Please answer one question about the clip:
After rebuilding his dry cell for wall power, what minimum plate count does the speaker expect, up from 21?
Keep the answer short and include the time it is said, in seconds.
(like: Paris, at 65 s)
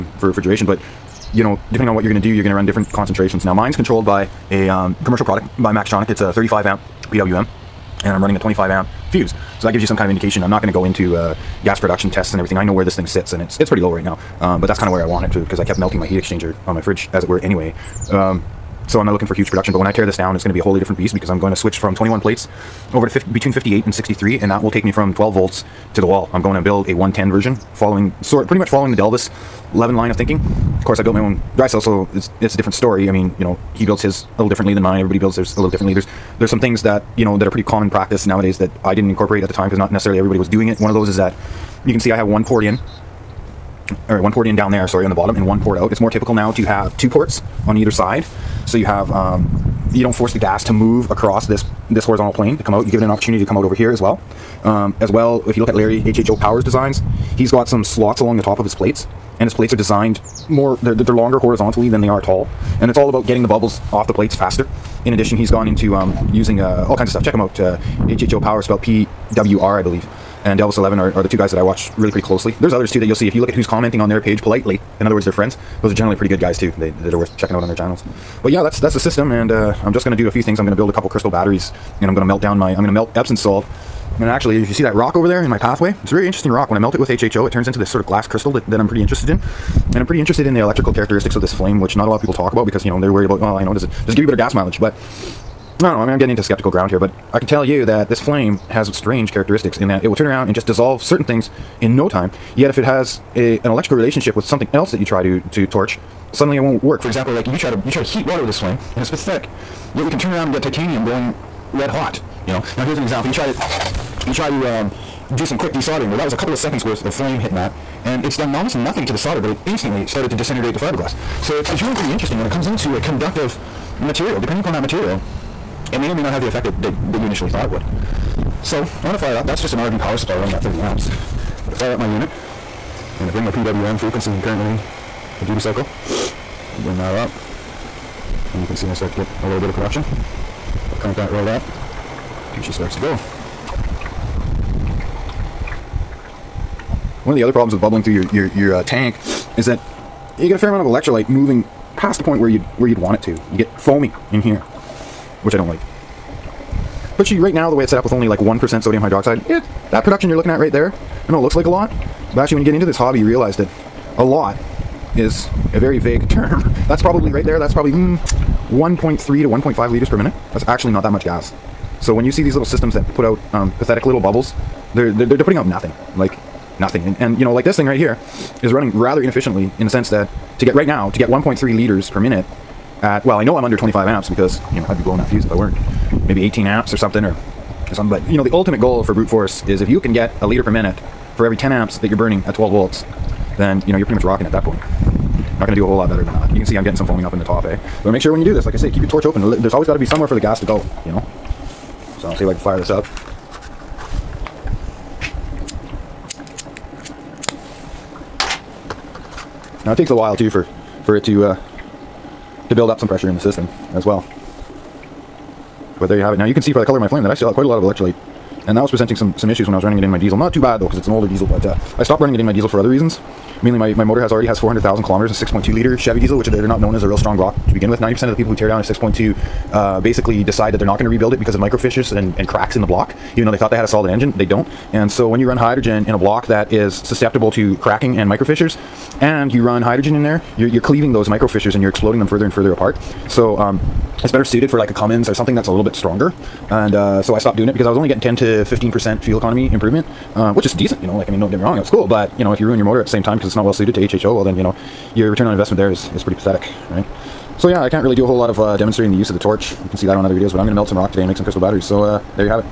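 58, at 23 s.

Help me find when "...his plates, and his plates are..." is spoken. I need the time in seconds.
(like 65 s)
58 s.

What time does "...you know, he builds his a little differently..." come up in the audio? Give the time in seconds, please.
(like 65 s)
33 s.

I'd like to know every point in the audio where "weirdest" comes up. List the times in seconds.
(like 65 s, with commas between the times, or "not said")
not said.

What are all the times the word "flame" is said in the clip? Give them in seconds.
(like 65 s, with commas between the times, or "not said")
91 s, 98 s, 108 s, 117 s, 217 s.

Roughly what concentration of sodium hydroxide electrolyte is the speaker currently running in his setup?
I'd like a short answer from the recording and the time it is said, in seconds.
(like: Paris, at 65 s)
1 percent, at 158 s.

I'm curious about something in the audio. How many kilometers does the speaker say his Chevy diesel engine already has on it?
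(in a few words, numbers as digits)
400,000 kilometers.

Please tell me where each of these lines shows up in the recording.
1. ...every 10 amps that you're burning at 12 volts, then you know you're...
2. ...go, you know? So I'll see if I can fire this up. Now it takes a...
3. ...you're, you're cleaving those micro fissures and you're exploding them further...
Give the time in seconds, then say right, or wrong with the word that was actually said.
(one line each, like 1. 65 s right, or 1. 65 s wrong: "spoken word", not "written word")
1. 191 s right
2. 200 s right
3. 240 s right.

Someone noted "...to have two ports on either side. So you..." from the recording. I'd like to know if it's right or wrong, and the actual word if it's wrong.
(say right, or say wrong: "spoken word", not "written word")
right.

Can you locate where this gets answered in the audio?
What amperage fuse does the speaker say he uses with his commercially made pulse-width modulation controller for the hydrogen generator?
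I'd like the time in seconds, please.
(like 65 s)
8 s.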